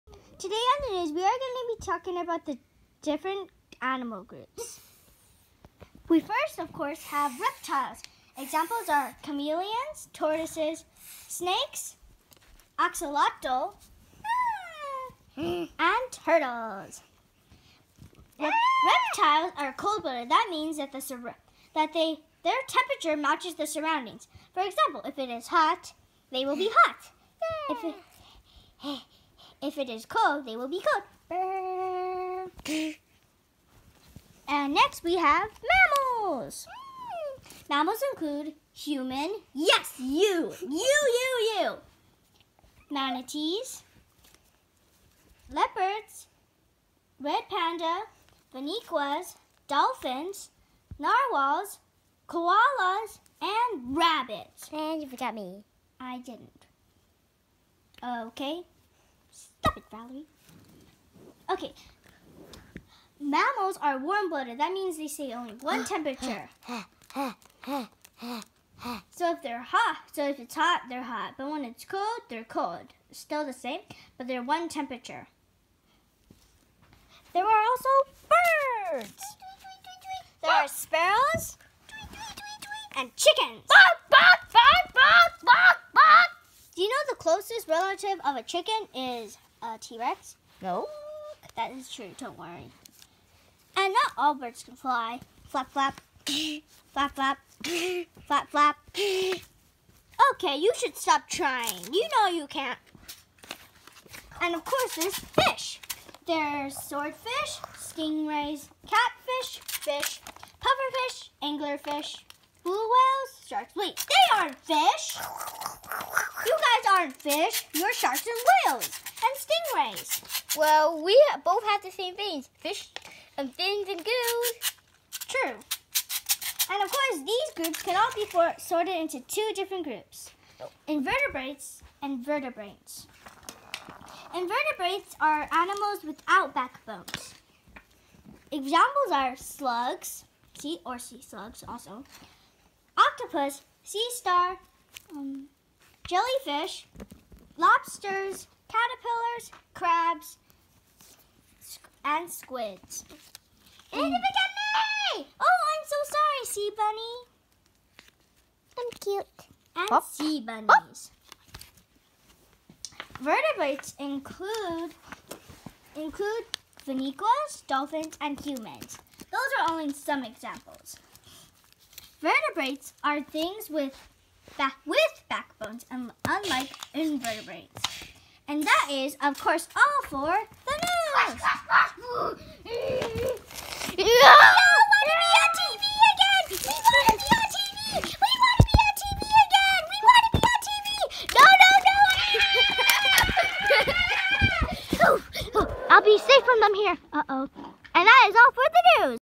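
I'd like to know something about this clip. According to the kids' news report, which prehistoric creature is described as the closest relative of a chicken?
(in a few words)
T-Rex.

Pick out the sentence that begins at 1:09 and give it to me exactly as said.
so if they're hot, so if it's hot, they're hot.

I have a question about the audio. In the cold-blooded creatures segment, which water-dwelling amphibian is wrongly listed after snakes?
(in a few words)
axolotl.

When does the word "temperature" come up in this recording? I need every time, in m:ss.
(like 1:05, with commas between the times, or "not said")
0:22, 1:05, 1:14.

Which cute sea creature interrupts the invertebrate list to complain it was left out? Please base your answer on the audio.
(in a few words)
Sea Bunny.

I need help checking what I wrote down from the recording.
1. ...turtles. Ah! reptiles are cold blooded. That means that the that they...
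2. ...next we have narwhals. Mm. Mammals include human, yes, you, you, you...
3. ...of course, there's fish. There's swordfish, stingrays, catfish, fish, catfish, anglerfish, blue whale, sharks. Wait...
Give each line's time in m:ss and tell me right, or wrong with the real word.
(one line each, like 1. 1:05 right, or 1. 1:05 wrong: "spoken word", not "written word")
1. 0:16 right
2. 0:34 wrong: "mammals", not "narwhals"
3. 1:44 wrong: "pufferfish", not "catfish".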